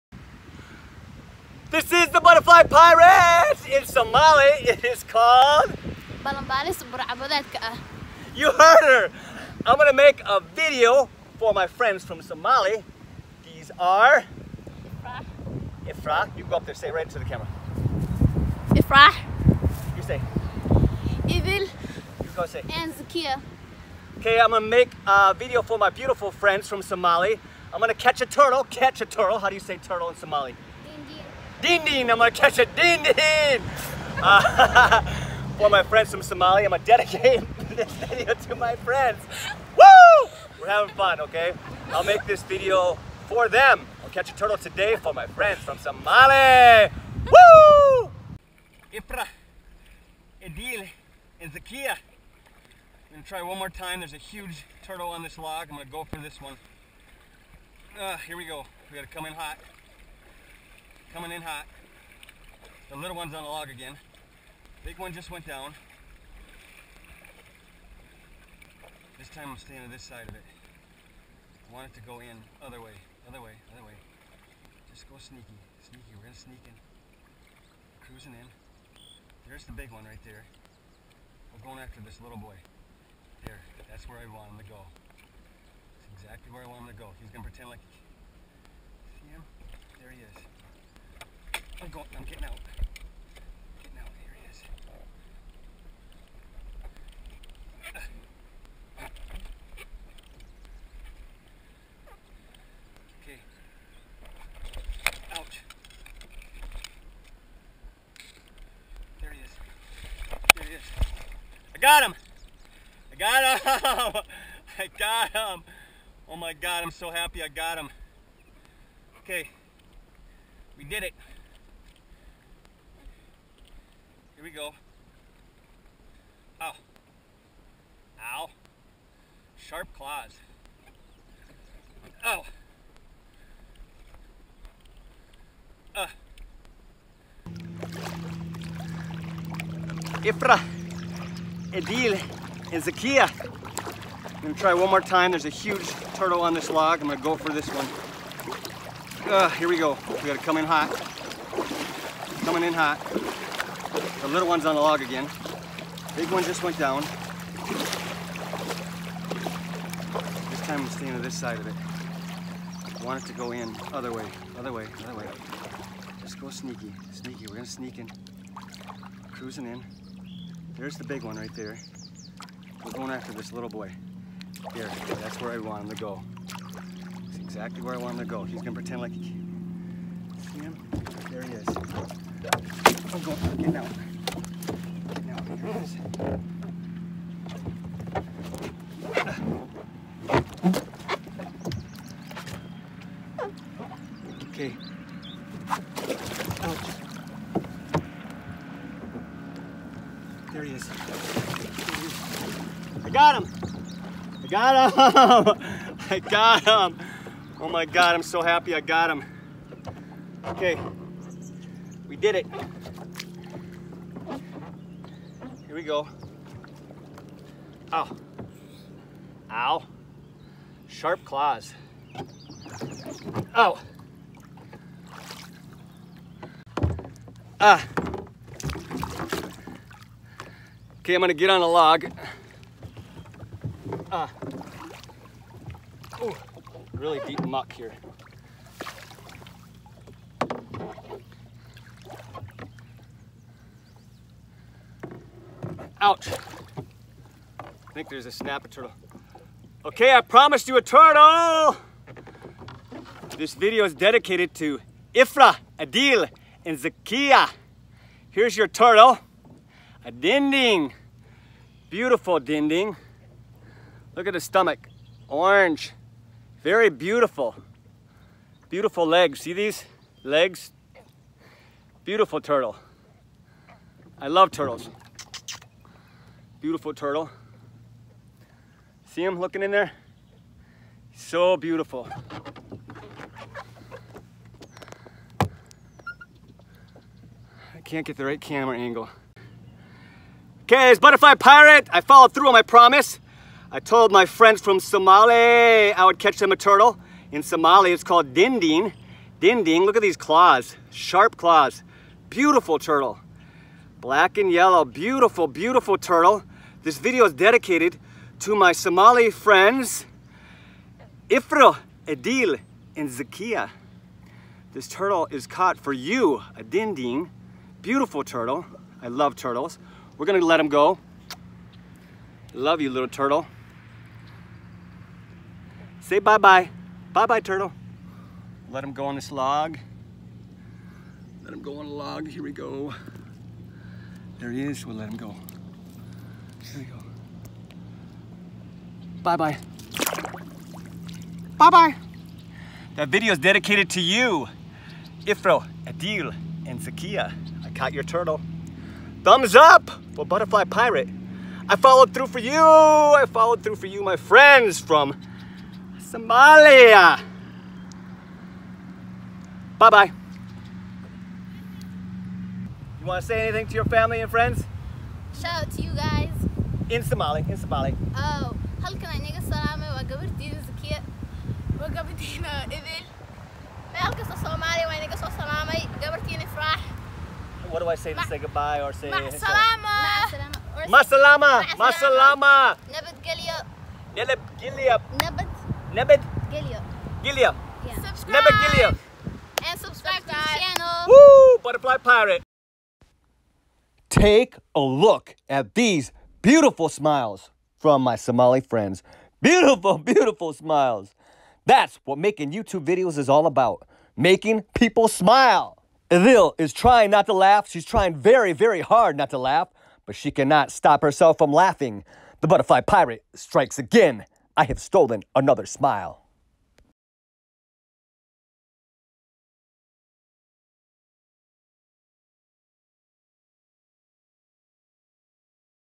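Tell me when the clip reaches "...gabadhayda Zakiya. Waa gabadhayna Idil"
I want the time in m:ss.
6:10.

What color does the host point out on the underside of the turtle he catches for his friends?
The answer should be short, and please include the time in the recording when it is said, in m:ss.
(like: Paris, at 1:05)
Orange, at 4:25.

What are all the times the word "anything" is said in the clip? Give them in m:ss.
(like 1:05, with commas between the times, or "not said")
6:03.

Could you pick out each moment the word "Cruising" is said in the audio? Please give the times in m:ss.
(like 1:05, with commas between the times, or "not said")
1:18, 2:49.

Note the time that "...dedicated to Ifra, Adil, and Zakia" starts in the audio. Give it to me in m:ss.
4:13.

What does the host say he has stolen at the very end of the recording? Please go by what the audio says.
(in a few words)
Another smile.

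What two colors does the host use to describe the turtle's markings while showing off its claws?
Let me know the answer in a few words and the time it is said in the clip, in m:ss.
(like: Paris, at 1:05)
Black and yellow, at 5:03.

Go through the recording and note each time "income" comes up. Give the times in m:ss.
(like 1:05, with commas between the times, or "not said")
not said.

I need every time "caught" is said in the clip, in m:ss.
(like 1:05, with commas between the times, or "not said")
5:15, 5:47.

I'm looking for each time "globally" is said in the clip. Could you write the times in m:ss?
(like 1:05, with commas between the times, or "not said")
not said.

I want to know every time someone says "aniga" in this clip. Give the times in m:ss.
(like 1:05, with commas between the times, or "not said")
6:09, 6:14.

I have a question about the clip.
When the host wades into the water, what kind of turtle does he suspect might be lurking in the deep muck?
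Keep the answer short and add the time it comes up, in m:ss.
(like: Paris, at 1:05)
Snapper turtle, at 4:08.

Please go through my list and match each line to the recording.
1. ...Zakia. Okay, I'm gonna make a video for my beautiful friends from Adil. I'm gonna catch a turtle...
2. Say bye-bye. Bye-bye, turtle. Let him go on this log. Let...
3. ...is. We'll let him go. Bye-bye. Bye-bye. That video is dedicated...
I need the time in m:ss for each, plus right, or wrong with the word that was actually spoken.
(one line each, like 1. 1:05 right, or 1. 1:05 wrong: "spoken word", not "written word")
1. 0:22 wrong: "Somali", not "Adil"
2. 5:25 right
3. 5:34 right.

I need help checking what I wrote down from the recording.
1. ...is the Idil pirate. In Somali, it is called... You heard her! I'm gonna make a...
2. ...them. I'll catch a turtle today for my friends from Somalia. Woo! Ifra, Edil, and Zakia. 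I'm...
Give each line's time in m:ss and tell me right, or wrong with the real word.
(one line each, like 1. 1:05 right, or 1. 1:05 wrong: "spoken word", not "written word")
1. 0:01 wrong: "Butterfly", not "Idil"
2. 0:43 right.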